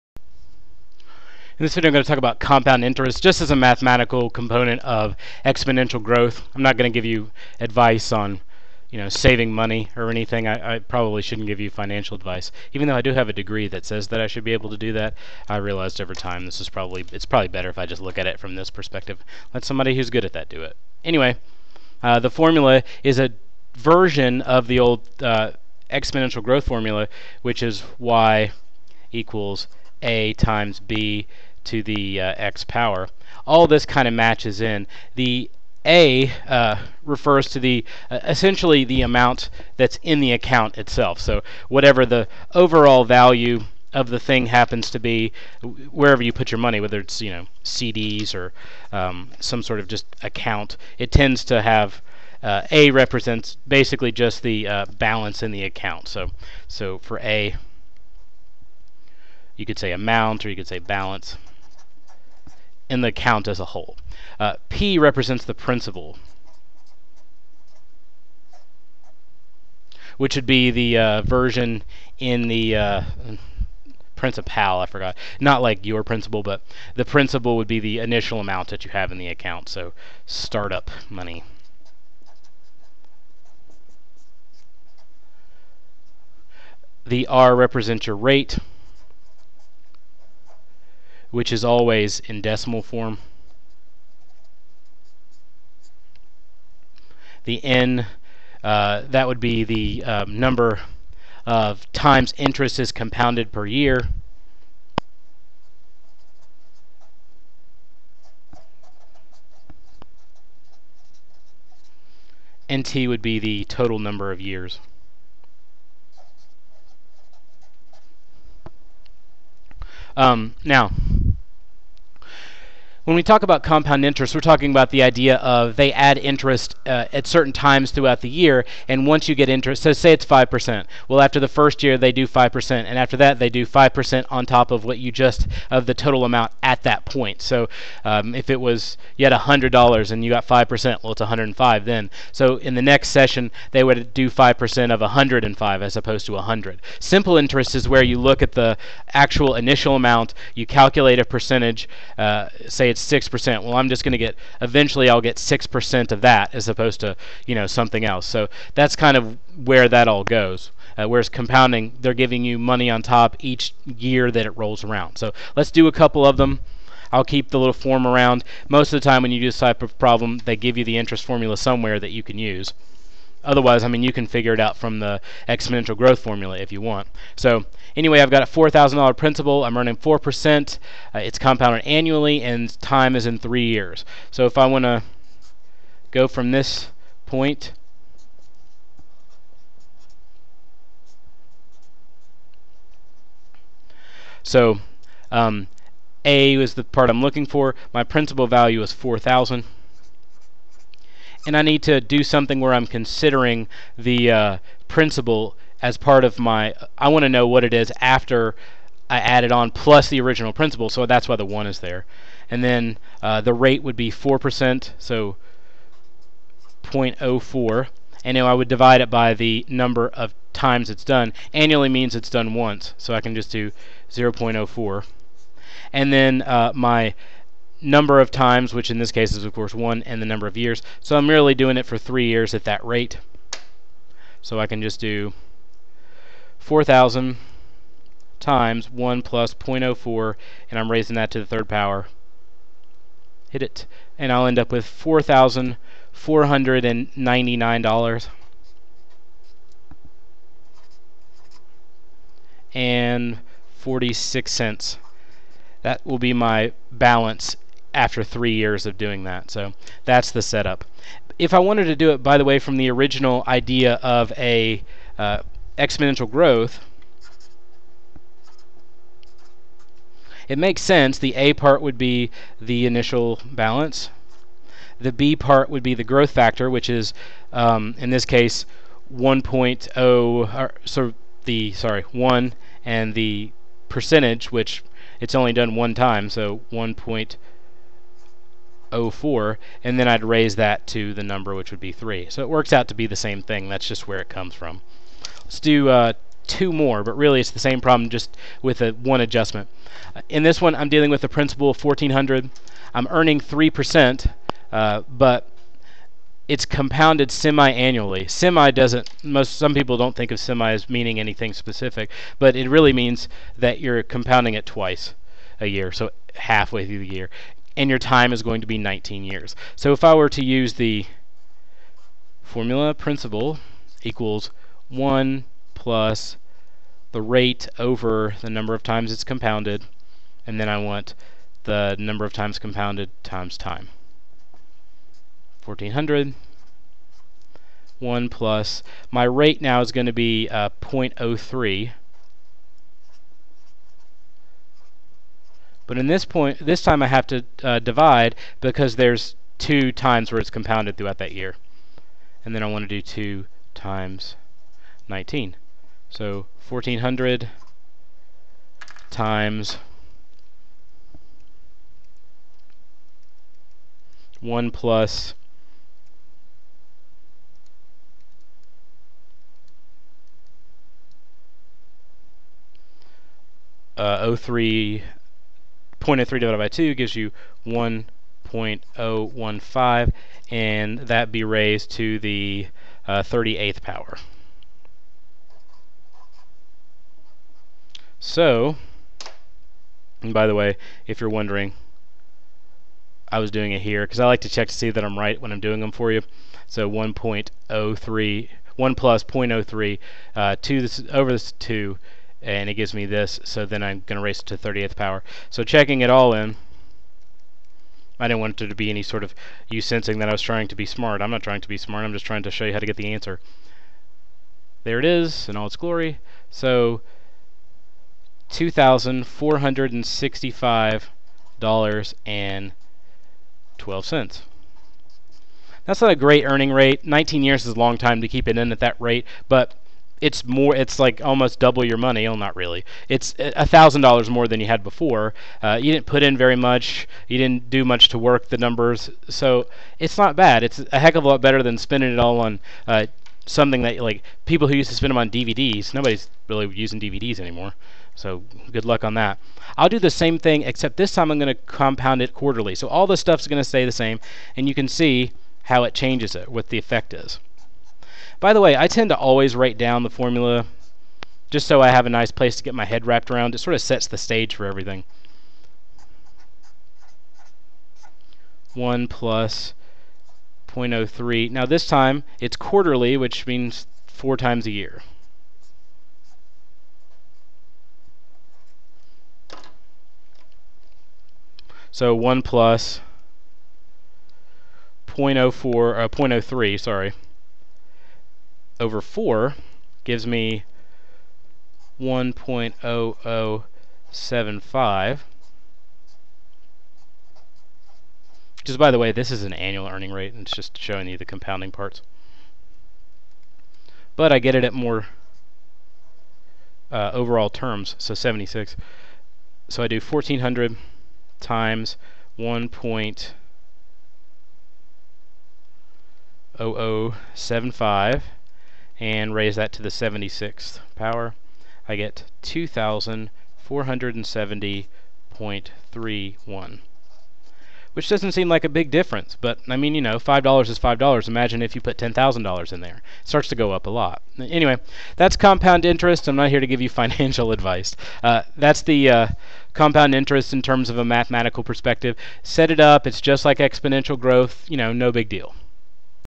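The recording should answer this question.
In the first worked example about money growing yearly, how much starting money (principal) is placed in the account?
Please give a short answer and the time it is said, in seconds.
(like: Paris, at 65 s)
$4,000, at 178 s.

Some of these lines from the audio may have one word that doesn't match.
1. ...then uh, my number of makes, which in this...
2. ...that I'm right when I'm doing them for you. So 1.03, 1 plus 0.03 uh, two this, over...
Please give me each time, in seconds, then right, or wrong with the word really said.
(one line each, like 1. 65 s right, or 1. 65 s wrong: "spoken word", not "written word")
1. 226 s wrong: "times", not "makes"
2. 394 s right.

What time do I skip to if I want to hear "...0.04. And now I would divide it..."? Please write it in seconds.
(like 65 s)
216 s.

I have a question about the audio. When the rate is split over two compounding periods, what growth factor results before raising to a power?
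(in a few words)
1.015.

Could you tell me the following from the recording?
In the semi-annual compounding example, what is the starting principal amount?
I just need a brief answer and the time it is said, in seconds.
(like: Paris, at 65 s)
1400, at 301 s.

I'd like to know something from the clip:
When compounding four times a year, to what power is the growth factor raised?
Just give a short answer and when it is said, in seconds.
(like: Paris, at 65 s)
76, at 519 s.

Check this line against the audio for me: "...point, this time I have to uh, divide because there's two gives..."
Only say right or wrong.
wrong.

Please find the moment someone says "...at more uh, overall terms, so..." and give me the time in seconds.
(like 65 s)
504 s.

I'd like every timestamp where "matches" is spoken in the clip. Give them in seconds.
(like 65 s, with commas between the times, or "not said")
34 s.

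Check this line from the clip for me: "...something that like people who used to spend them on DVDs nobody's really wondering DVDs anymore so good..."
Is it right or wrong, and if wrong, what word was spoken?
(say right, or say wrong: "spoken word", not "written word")
wrong: "using", not "wondering".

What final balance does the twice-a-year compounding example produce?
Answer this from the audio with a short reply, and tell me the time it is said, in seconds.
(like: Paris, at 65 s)
$2,465.12, at 418 s.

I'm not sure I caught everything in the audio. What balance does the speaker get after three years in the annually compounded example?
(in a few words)
$4,499.46.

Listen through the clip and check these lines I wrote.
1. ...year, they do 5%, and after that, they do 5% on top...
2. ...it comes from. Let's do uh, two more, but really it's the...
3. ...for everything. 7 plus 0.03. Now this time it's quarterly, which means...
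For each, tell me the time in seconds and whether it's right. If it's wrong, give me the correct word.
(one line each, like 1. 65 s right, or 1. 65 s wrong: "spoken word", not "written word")
1. 131 s right
2. 294 s right
3. 464 s wrong: "1", not "7".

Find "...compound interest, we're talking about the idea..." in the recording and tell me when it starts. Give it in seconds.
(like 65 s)
123 s.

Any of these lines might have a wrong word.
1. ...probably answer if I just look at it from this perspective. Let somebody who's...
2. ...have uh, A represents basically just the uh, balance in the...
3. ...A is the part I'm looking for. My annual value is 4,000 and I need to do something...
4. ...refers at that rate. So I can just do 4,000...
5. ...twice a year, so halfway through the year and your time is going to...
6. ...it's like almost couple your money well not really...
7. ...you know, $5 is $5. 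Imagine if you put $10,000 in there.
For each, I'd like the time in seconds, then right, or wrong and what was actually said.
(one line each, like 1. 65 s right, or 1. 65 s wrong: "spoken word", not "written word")
1. 17 s wrong: "better", not "answer"
2. 51 s right
3. 196 s wrong: "principal", not "annual"
4. 232 s wrong: "years", not "refers"
5. 314 s right
6. 430 s wrong: "double", not "couple"
7. 529 s right.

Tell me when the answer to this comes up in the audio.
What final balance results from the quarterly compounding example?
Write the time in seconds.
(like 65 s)
522 s.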